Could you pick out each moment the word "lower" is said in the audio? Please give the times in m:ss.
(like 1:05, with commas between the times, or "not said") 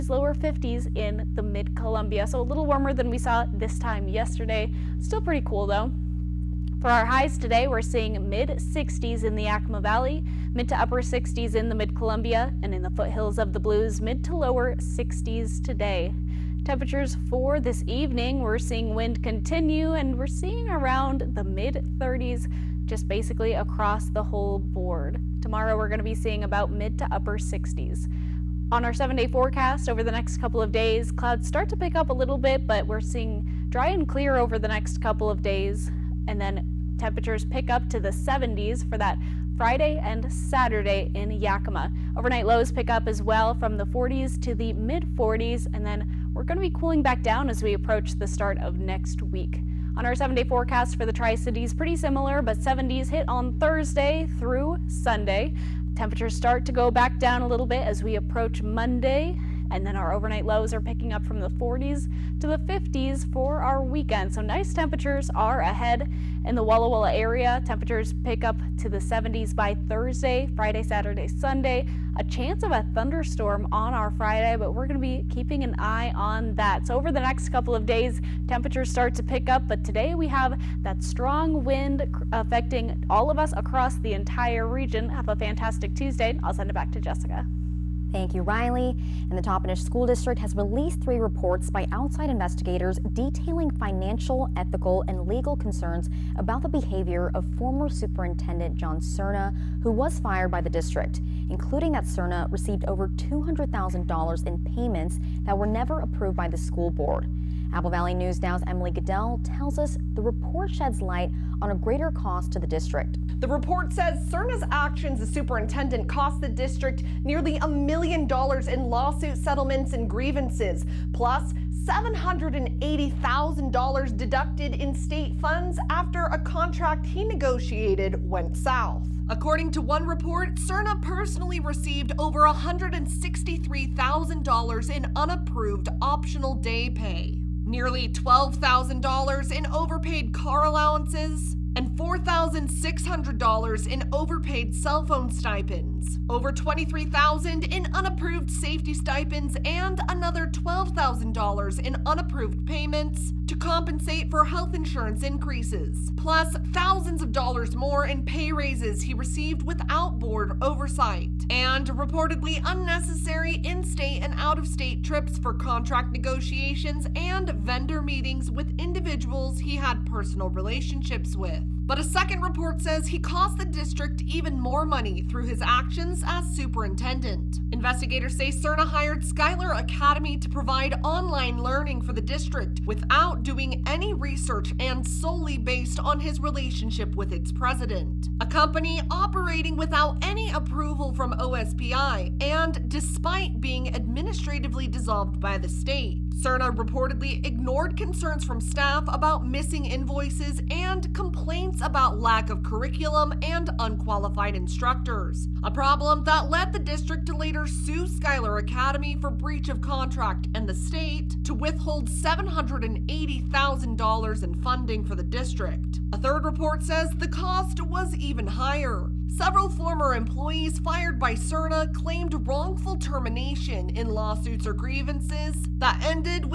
0:00, 0:14.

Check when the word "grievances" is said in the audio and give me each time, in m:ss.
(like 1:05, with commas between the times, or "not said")
2:00, 3:44.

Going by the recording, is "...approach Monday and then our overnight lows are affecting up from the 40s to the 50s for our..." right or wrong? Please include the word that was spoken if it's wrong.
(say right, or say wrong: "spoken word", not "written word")
wrong: "picking", not "affecting".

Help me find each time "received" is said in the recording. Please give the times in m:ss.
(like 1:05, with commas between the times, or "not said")
1:42, 2:11, 2:39.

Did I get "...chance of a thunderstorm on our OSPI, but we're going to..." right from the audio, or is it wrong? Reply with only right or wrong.
wrong.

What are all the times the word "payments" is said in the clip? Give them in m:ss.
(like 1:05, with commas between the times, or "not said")
1:44, 2:32.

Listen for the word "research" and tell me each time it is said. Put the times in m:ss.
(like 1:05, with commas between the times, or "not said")
3:04.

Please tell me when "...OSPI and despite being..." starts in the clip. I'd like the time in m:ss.
3:11.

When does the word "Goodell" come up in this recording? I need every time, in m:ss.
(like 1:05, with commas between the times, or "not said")
1:48.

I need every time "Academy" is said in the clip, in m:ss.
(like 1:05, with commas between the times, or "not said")
2:59, 3:28.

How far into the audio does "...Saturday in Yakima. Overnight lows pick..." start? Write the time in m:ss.
0:40.